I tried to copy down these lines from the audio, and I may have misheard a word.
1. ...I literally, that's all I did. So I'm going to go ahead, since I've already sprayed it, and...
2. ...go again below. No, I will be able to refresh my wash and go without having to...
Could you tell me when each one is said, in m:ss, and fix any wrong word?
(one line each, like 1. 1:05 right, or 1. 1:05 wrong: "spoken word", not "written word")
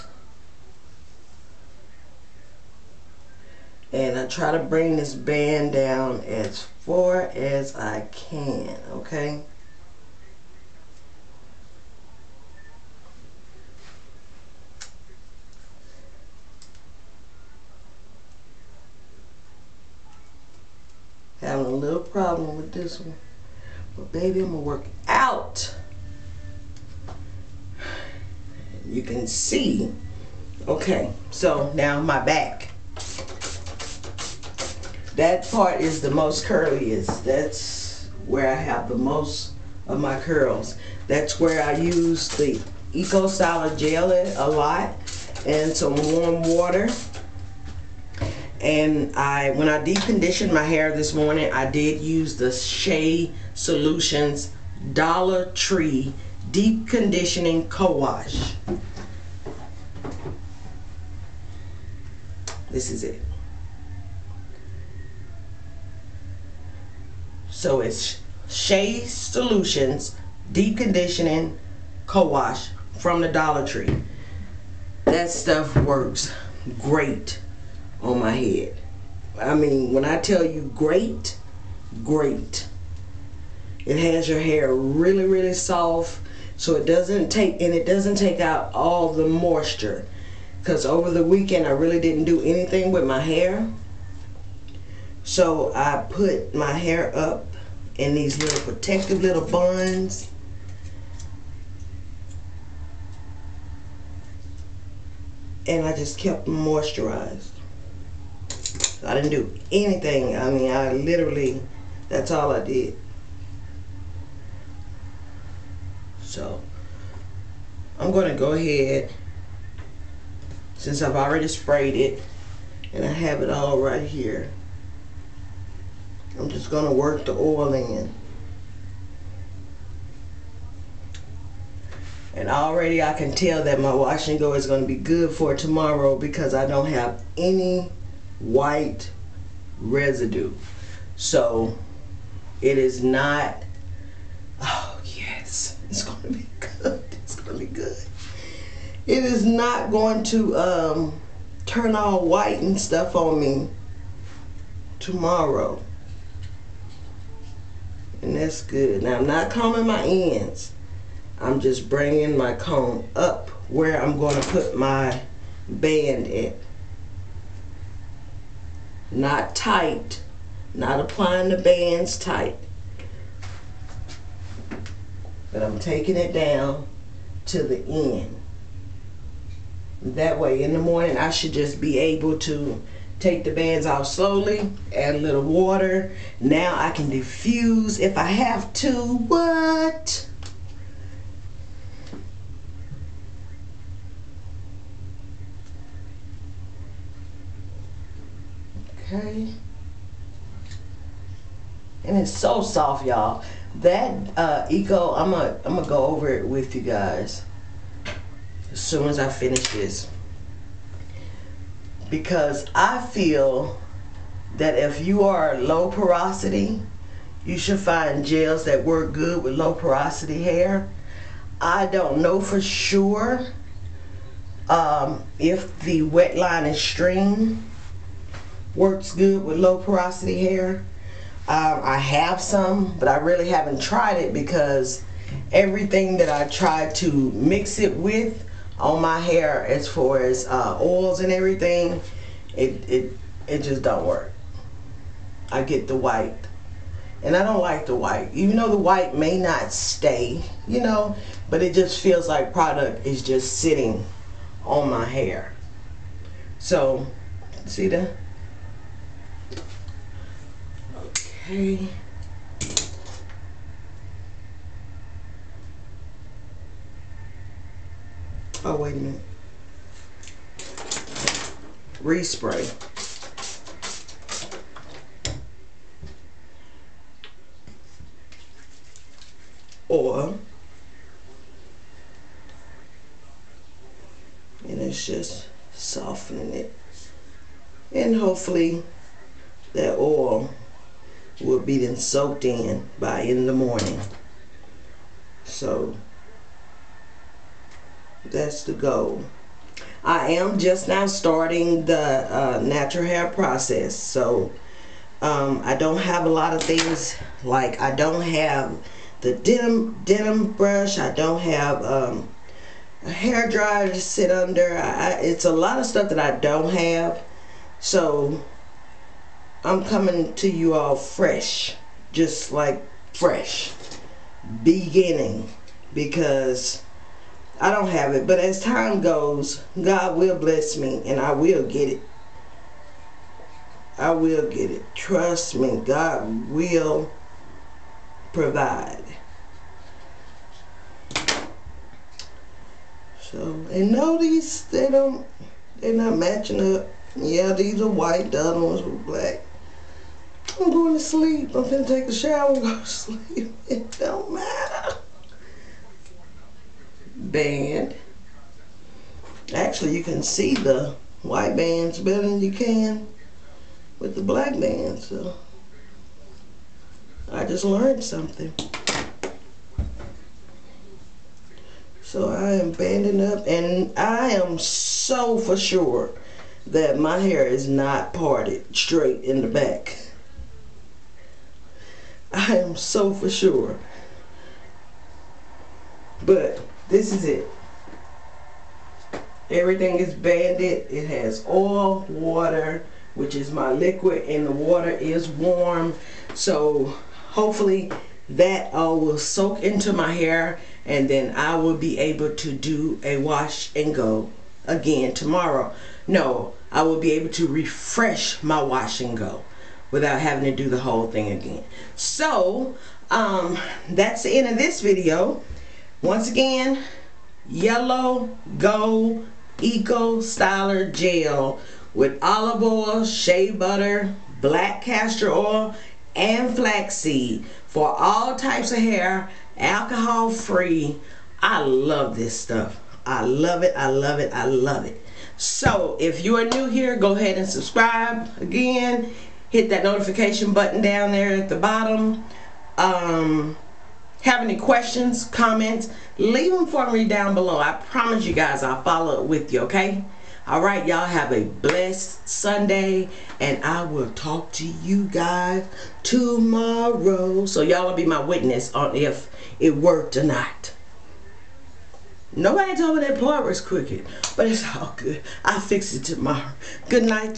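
1. 1:50 right
2. 6:43 wrong: "tomorrow", not "below".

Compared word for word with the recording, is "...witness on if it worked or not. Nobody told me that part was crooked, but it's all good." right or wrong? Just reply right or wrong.
right.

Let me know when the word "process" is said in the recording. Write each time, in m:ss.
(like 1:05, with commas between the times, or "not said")
5:03.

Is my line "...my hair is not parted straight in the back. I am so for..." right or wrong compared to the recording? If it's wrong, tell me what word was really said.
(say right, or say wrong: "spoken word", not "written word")
right.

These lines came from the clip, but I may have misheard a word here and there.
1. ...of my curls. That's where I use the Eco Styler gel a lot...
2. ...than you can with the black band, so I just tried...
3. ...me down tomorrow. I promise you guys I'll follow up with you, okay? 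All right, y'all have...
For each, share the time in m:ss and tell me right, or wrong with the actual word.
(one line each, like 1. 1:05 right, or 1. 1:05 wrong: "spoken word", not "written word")
1. 0:39 right
2. 6:02 wrong: "learned", not "tried"
3. 7:26 wrong: "below", not "tomorrow".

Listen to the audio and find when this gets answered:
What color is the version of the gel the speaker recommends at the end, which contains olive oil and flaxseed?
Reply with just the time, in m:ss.
6:57.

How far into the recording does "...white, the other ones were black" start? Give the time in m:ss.
5:47.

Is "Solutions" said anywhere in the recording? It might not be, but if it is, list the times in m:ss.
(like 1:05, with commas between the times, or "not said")
0:53, 1:09.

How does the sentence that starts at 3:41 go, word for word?
I don't know for sure um, if the Wetline Xtreme works good with low porosity hair.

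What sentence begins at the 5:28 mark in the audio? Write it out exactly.
But as time goes, God will bless me and I will get it.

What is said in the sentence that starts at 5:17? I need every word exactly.
So I'm coming to you all fresh.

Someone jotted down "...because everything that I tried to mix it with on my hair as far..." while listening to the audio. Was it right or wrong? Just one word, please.
right.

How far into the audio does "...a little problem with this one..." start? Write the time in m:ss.
0:21.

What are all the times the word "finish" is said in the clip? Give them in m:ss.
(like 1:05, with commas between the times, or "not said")
3:29.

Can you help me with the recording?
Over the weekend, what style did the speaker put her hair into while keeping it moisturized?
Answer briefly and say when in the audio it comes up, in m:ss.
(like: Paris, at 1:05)
protective little buns, at 1:38.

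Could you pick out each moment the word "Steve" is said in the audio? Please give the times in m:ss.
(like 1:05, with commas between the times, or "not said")
not said.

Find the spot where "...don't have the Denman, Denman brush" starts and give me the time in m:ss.
5:07.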